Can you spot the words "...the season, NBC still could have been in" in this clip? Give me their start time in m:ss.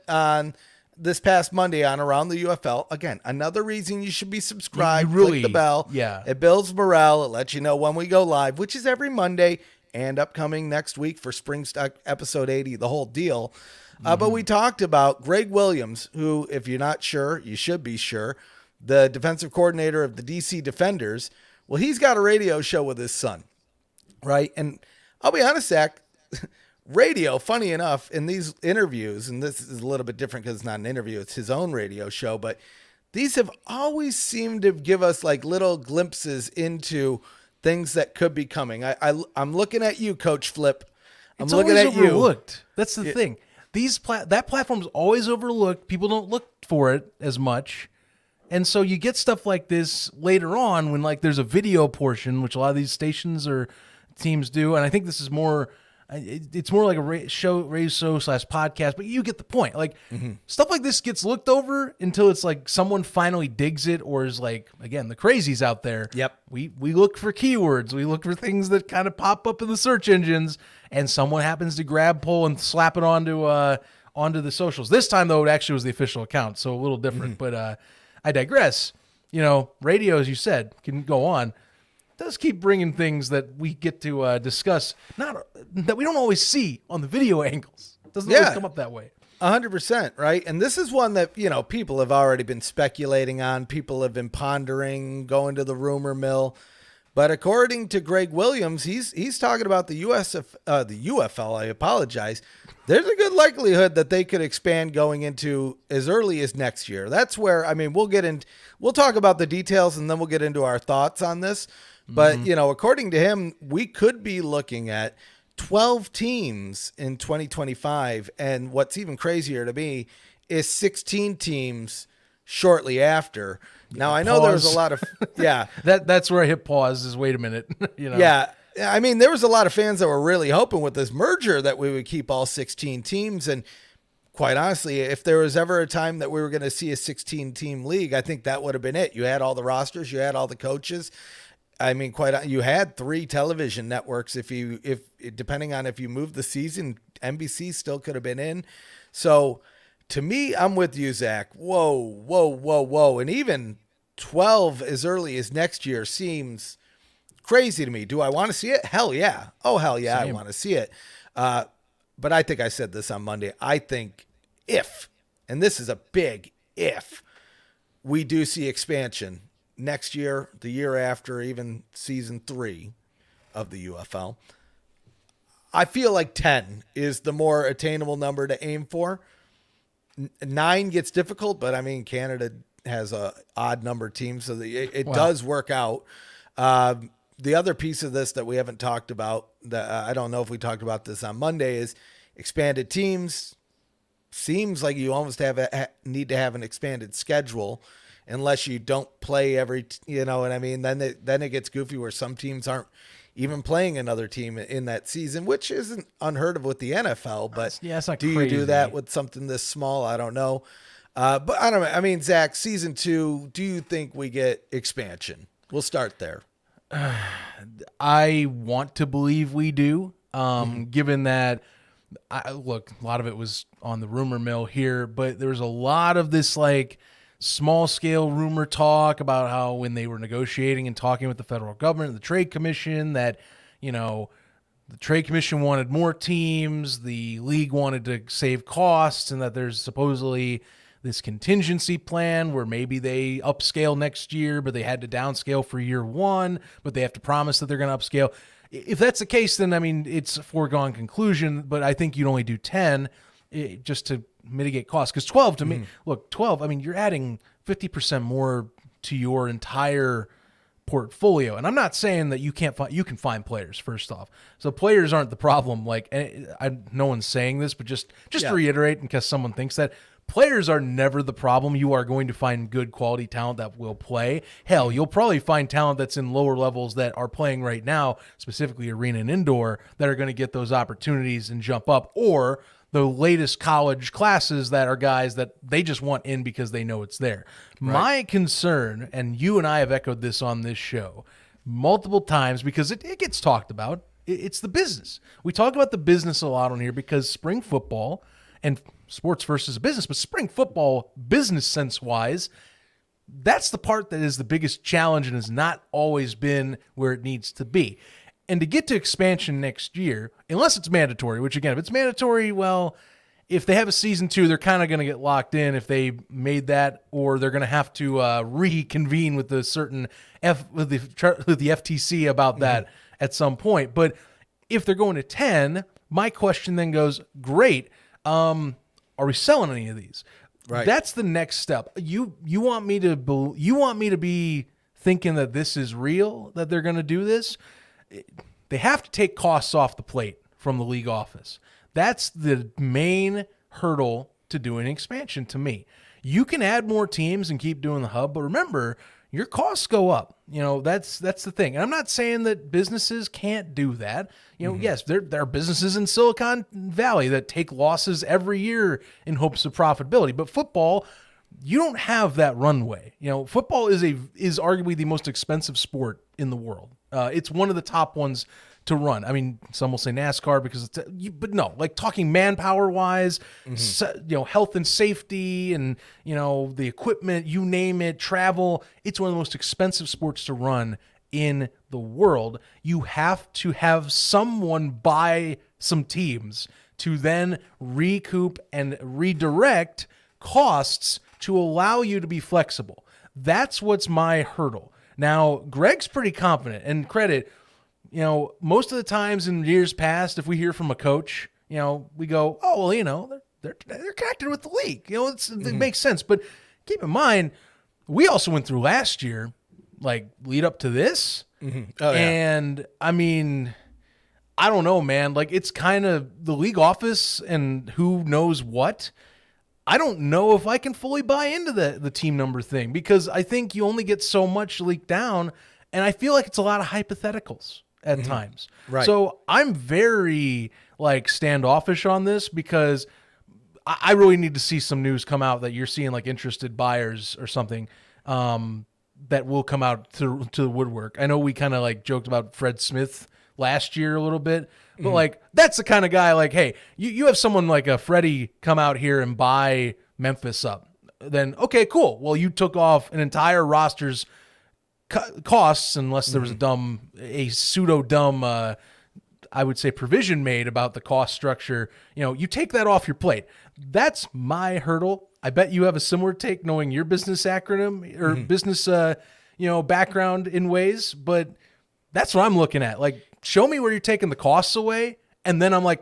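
2:26.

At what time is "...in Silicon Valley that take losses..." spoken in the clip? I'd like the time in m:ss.
5:55.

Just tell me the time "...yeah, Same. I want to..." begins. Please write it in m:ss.
2:39.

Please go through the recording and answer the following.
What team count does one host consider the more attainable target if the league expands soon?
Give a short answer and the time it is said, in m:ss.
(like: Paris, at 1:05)
10, at 2:56.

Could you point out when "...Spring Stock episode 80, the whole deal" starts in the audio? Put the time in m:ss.
0:11.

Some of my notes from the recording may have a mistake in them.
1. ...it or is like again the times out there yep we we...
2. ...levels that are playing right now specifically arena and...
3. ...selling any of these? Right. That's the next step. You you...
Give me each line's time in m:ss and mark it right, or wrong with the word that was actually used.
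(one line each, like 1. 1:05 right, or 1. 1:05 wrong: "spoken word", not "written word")
1. 1:03 wrong: "crazies", not "times"
2. 4:36 right
3. 5:29 right.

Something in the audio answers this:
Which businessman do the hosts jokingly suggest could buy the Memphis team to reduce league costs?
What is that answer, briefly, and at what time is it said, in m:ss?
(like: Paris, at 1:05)
Fred Smith, at 7:22.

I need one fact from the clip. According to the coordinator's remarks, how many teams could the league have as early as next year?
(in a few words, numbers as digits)
12.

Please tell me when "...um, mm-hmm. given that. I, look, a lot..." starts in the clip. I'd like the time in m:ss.
3:40.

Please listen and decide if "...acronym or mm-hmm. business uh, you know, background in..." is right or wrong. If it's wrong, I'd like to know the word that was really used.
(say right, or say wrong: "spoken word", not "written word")
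right.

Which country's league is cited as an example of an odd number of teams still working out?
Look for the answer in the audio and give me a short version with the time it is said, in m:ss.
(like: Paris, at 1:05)
Canada, at 3:02.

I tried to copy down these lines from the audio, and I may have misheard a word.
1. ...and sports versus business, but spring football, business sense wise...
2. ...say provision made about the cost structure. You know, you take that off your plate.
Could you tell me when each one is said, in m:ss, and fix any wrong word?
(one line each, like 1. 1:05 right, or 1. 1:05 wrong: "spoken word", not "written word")
1. 4:58 right
2. 7:39 right.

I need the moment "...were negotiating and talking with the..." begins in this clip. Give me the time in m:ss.
3:50.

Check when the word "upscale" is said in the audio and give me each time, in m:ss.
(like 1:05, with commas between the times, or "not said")
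4:03, 4:07.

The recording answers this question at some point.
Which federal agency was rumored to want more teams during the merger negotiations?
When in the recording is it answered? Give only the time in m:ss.
5:21.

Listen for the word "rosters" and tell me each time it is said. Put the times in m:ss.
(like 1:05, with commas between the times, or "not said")
2:19, 7:33.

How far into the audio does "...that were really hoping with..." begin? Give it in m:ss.
2:09.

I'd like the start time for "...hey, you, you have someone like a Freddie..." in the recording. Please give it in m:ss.
7:26.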